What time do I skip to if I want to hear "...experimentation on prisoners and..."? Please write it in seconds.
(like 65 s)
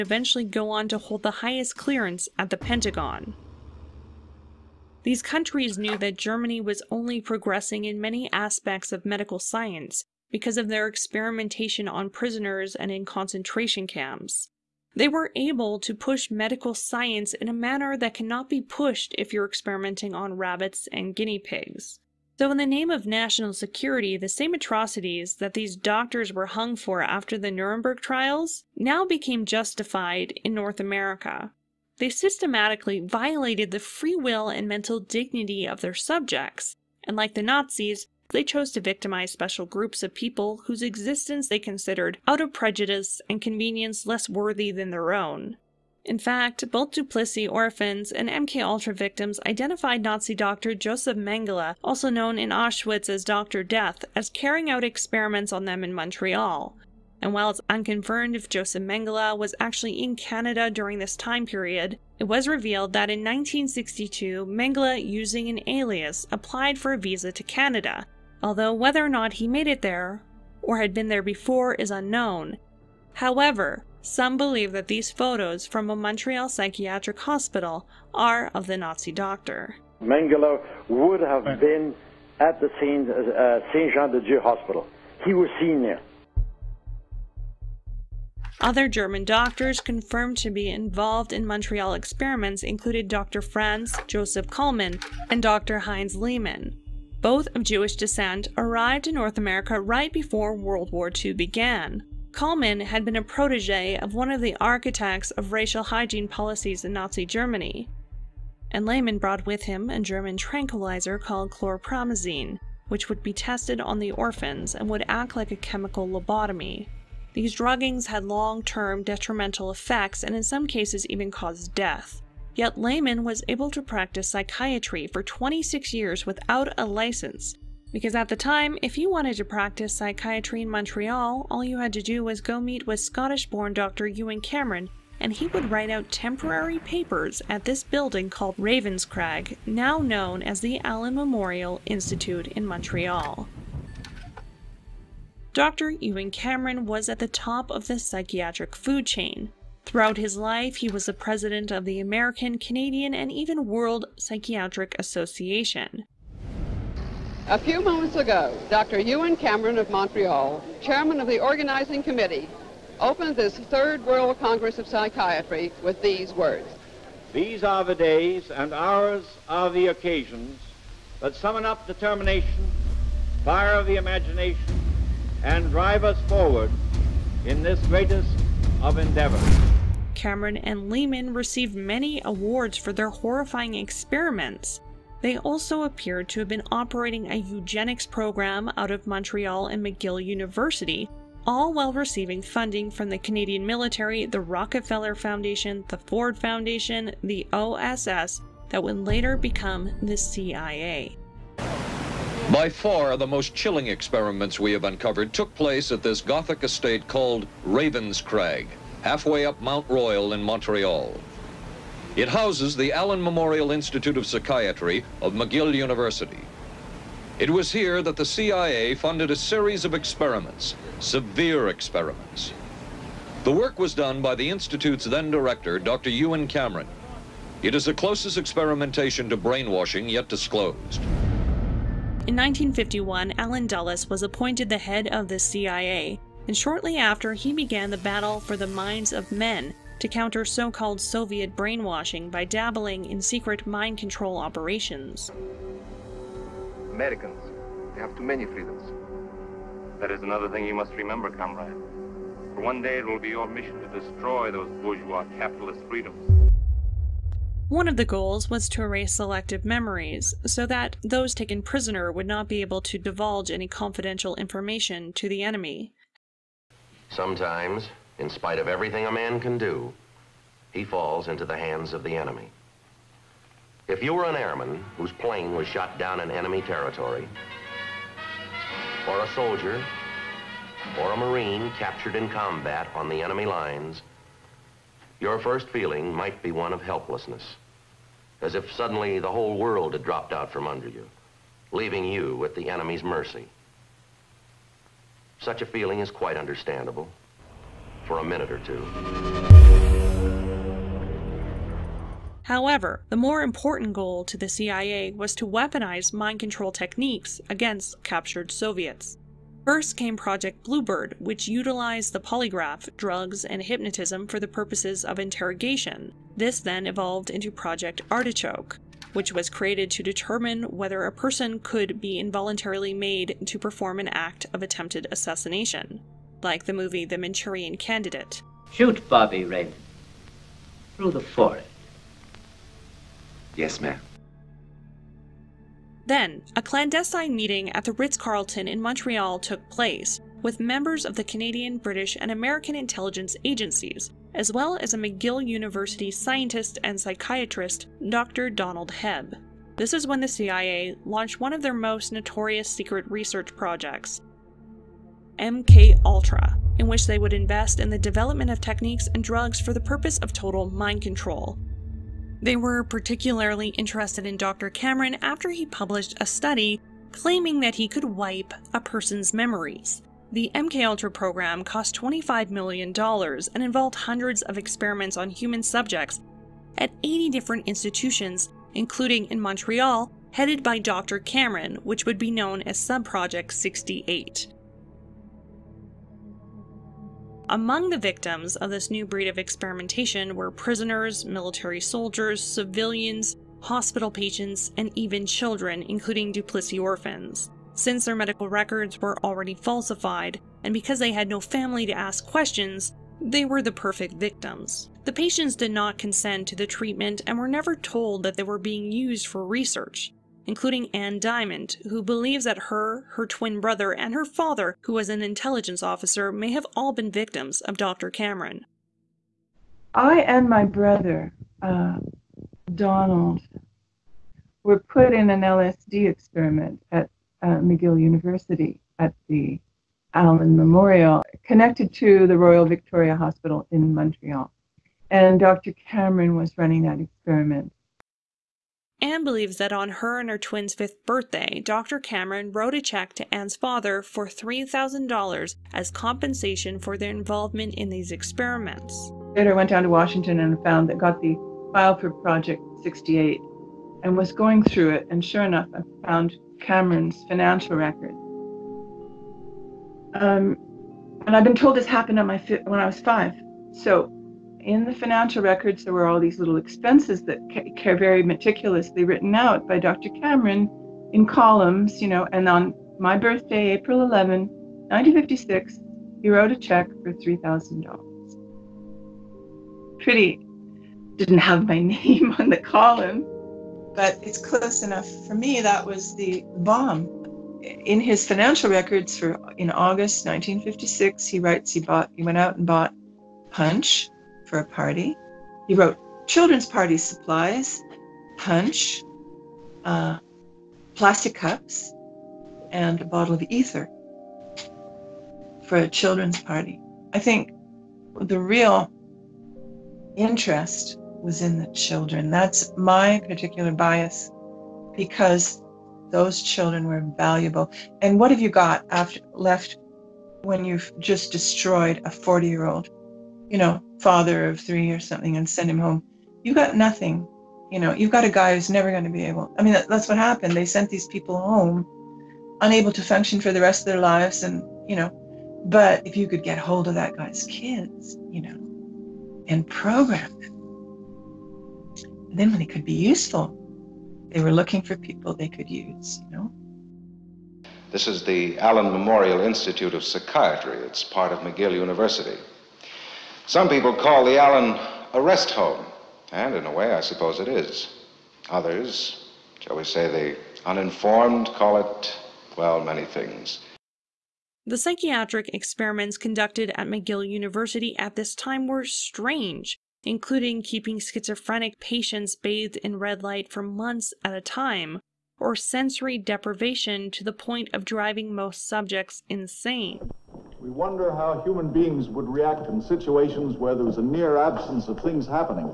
10 s.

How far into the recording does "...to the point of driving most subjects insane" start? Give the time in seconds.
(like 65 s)
577 s.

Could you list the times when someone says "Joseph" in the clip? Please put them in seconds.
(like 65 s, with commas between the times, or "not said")
50 s, 58 s, 94 s.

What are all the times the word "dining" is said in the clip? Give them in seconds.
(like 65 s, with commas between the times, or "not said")
not said.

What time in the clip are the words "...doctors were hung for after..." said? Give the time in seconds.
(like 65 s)
25 s.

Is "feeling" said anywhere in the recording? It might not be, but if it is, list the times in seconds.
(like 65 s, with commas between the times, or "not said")
285 s, 295 s.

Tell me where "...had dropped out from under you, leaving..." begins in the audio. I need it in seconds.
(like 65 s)
289 s.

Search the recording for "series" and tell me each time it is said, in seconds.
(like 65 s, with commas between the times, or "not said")
219 s.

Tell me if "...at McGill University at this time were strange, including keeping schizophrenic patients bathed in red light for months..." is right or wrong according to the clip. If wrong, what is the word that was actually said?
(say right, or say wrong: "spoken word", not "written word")
right.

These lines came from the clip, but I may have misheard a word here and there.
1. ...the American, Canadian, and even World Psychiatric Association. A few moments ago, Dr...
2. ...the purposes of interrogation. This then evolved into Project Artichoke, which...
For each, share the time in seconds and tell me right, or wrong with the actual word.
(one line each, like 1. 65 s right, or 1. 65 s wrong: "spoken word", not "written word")
1. 151 s right
2. 314 s right.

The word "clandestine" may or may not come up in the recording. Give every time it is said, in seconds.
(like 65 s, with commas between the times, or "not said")
336 s.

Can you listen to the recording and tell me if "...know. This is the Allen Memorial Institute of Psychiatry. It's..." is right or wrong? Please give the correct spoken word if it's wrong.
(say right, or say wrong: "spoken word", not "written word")
right.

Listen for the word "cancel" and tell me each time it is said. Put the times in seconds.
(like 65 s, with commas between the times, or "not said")
not said.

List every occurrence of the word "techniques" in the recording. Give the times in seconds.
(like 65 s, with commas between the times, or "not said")
306 s, 358 s.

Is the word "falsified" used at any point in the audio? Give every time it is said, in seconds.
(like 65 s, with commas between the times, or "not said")
399 s.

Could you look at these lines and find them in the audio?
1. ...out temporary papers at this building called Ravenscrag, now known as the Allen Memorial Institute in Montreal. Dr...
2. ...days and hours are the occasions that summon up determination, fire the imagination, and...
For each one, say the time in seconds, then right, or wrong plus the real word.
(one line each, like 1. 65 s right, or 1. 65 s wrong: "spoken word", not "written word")
1. 135 s right
2. 167 s right.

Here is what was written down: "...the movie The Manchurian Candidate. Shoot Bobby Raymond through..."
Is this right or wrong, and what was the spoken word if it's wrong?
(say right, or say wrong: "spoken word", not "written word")
right.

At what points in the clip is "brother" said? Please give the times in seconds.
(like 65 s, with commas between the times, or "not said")
413 s, 420 s.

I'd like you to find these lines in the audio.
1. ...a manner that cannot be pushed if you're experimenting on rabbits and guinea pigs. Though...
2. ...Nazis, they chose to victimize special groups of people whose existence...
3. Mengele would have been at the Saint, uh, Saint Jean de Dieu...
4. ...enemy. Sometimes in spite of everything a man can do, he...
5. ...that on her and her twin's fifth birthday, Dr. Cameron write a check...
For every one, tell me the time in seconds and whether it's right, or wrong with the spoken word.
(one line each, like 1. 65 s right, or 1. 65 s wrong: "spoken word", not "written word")
1. 17 s right
2. 37 s right
3. 80 s right
4. 265 s right
5. 439 s wrong: "wrote", not "write".